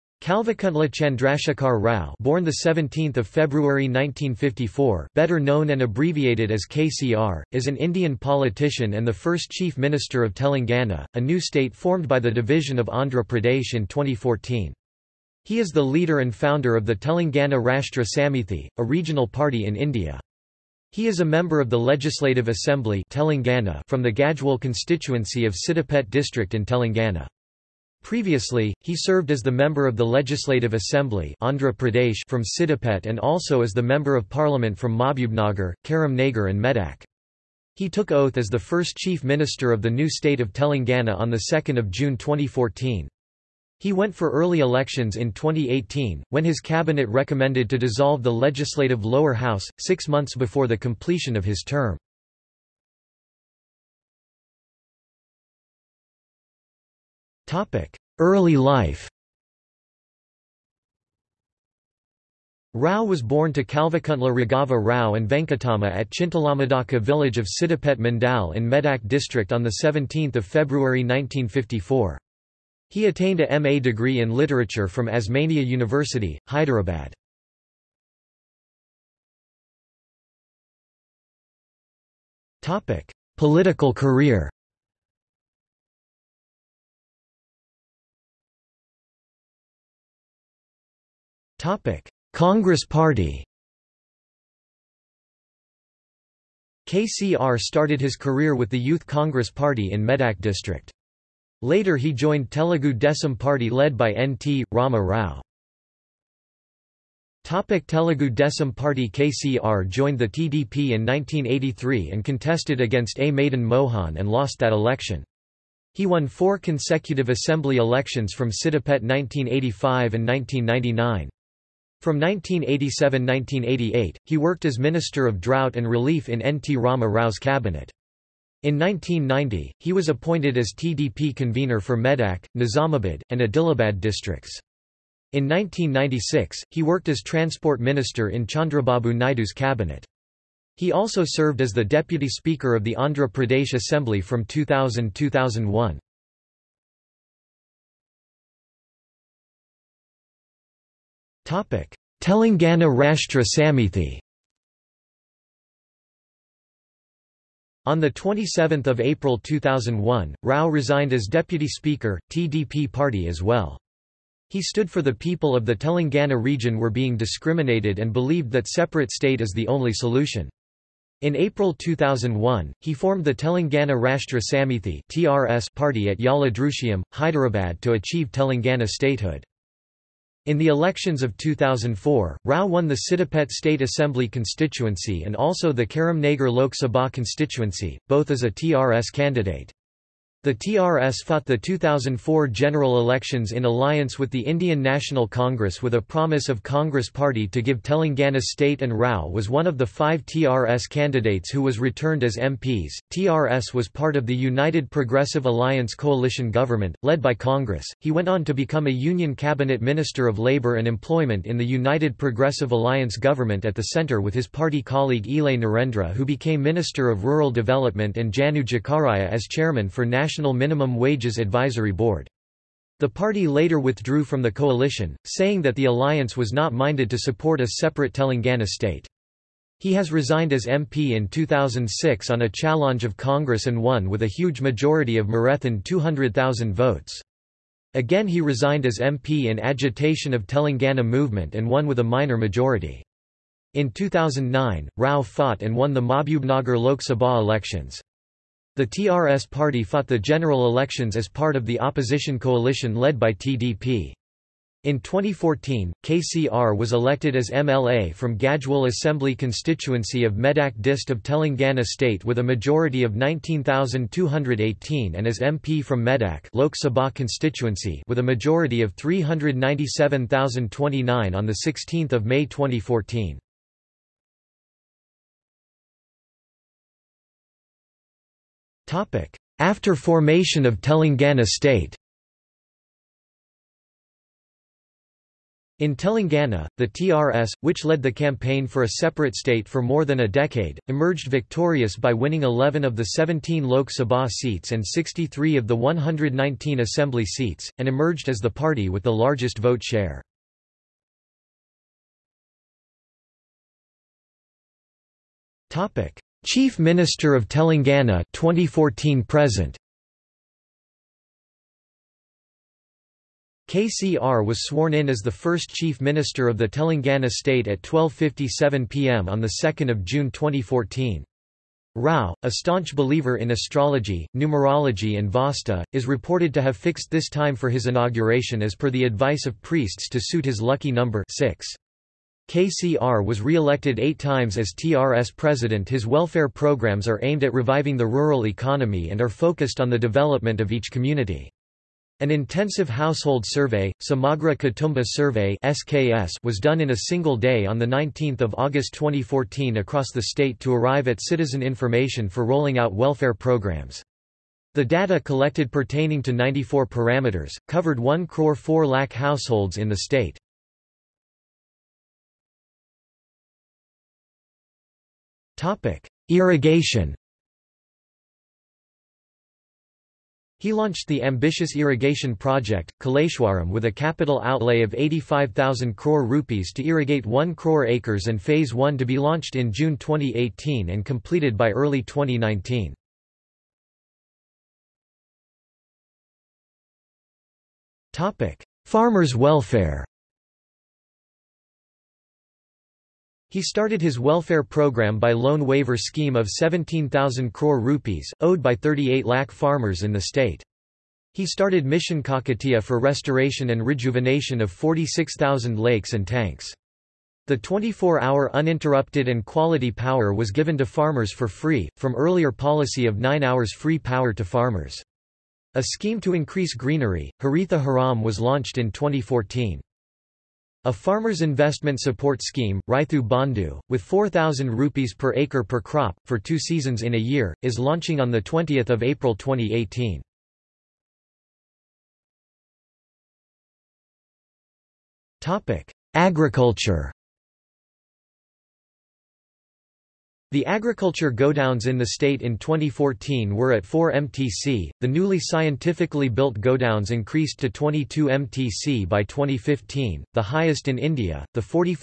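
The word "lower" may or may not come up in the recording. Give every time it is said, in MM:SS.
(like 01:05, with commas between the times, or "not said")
00:49.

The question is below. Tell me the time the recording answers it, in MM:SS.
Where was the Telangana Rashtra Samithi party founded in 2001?
02:56.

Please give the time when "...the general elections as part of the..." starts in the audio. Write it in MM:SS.
04:10.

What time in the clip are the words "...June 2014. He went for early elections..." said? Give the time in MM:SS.
00:41.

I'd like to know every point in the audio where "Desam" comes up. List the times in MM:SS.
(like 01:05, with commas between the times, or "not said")
01:42, 01:48.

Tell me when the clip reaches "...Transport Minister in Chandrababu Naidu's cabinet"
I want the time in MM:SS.
02:17.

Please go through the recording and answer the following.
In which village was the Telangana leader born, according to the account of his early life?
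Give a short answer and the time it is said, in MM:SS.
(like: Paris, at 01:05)
Chintalamadaka, at 01:06.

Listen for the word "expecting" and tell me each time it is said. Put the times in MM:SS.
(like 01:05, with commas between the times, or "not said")
not said.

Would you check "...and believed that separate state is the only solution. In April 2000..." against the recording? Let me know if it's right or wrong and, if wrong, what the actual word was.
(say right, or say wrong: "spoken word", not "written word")
wrong: "2001", not "2000".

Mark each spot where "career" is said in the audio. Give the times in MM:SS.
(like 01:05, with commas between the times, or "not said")
01:23, 01:38.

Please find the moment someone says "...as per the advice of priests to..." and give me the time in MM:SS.
05:28.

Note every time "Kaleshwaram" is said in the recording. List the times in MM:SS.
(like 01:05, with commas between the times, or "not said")
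06:13.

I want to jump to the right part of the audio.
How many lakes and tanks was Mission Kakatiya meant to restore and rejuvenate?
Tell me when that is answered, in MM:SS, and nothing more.
06:44.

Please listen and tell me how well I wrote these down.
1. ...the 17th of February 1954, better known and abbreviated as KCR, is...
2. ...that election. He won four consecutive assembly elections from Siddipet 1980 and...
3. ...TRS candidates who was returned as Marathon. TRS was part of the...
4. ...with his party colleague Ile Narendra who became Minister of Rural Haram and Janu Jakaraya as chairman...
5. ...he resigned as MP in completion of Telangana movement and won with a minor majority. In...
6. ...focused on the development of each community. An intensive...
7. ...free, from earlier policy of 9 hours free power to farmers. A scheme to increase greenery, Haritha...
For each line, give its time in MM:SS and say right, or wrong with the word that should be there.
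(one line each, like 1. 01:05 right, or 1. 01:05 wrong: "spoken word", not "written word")
1. 00:02 right
2. 01:54 wrong: "1985", not "1980"
3. 03:20 wrong: "MPs", not "Marathon"
4. 03:34 wrong: "Development", not "Haram"
5. 03:58 wrong: "agitation", not "completion"
6. 05:39 right
7. 06:51 right.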